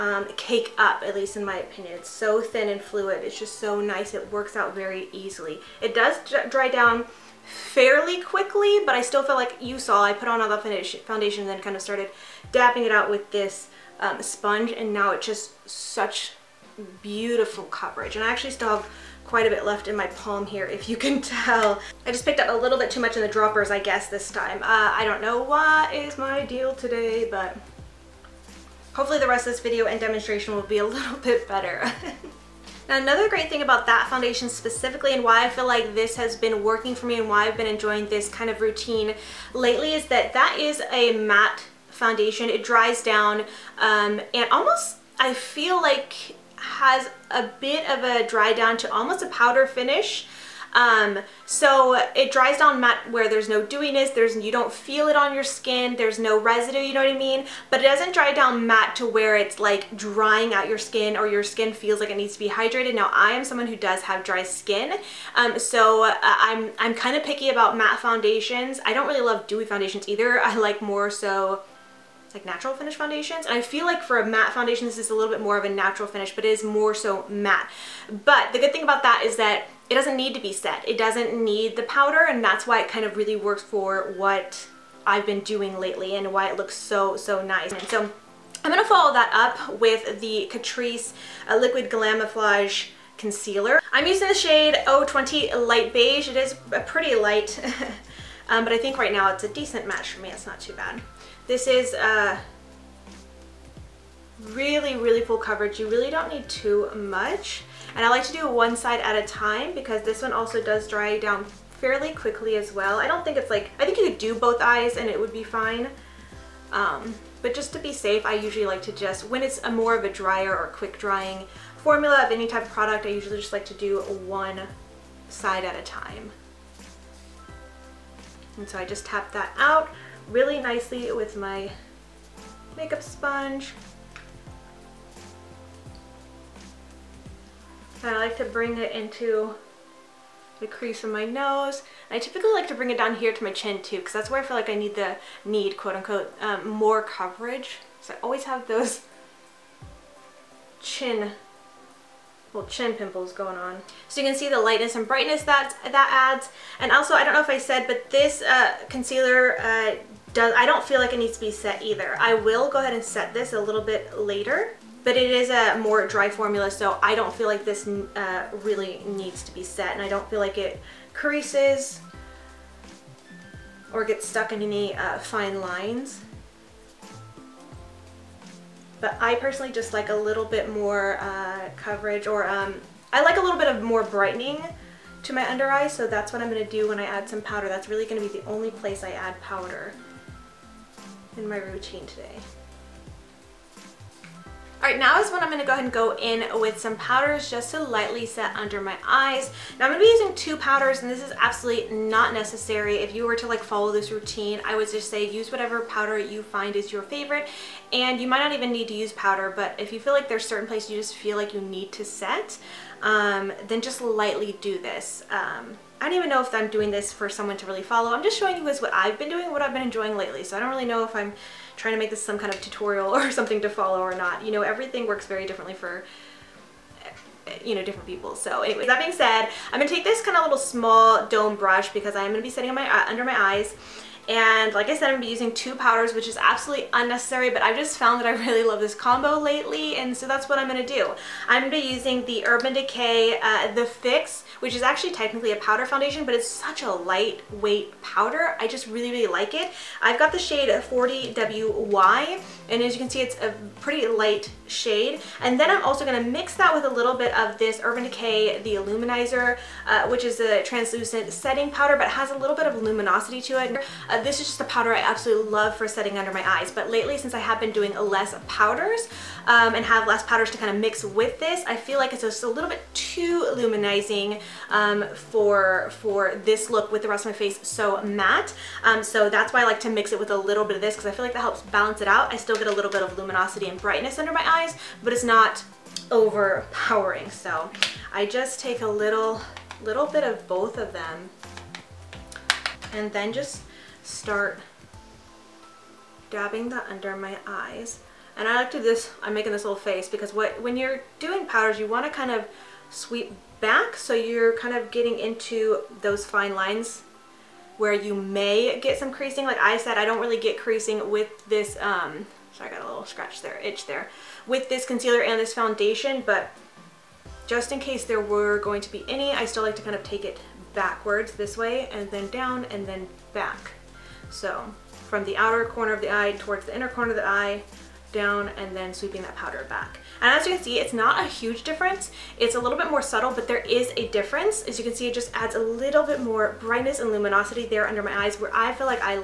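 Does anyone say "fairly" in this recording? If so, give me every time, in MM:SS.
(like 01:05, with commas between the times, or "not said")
00:07, 01:51.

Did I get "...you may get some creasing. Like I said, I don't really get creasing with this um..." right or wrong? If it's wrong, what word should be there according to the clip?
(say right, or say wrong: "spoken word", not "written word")
right.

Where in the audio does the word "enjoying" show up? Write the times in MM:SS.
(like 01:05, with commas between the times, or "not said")
00:37, 03:39.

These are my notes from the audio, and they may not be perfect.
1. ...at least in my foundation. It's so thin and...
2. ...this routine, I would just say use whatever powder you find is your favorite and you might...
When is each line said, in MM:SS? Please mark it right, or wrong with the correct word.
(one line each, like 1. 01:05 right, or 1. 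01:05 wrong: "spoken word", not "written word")
1. 00:01 wrong: "opinion", not "foundation"
2. 03:23 right.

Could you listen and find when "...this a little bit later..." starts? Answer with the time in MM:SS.
02:43.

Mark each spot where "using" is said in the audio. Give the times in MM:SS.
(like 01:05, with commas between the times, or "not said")
01:34, 03:20, 03:55, 04:01.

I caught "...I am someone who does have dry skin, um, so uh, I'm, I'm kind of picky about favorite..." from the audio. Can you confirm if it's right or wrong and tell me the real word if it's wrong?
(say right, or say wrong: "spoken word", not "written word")
wrong: "matte", not "favorite".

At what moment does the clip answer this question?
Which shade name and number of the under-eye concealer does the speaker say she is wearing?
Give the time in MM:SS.
01:34.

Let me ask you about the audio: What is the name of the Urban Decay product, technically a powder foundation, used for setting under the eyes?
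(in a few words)
The Fix.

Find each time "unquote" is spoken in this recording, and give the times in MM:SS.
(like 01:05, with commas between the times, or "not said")
02:25.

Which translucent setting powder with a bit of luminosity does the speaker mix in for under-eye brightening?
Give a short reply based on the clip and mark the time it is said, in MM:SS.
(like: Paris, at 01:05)
The Illuminizer, at 04:18.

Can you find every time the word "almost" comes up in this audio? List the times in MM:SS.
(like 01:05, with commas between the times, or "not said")
00:44, 00:48.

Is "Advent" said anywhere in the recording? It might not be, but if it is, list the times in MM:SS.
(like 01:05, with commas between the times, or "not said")
not said.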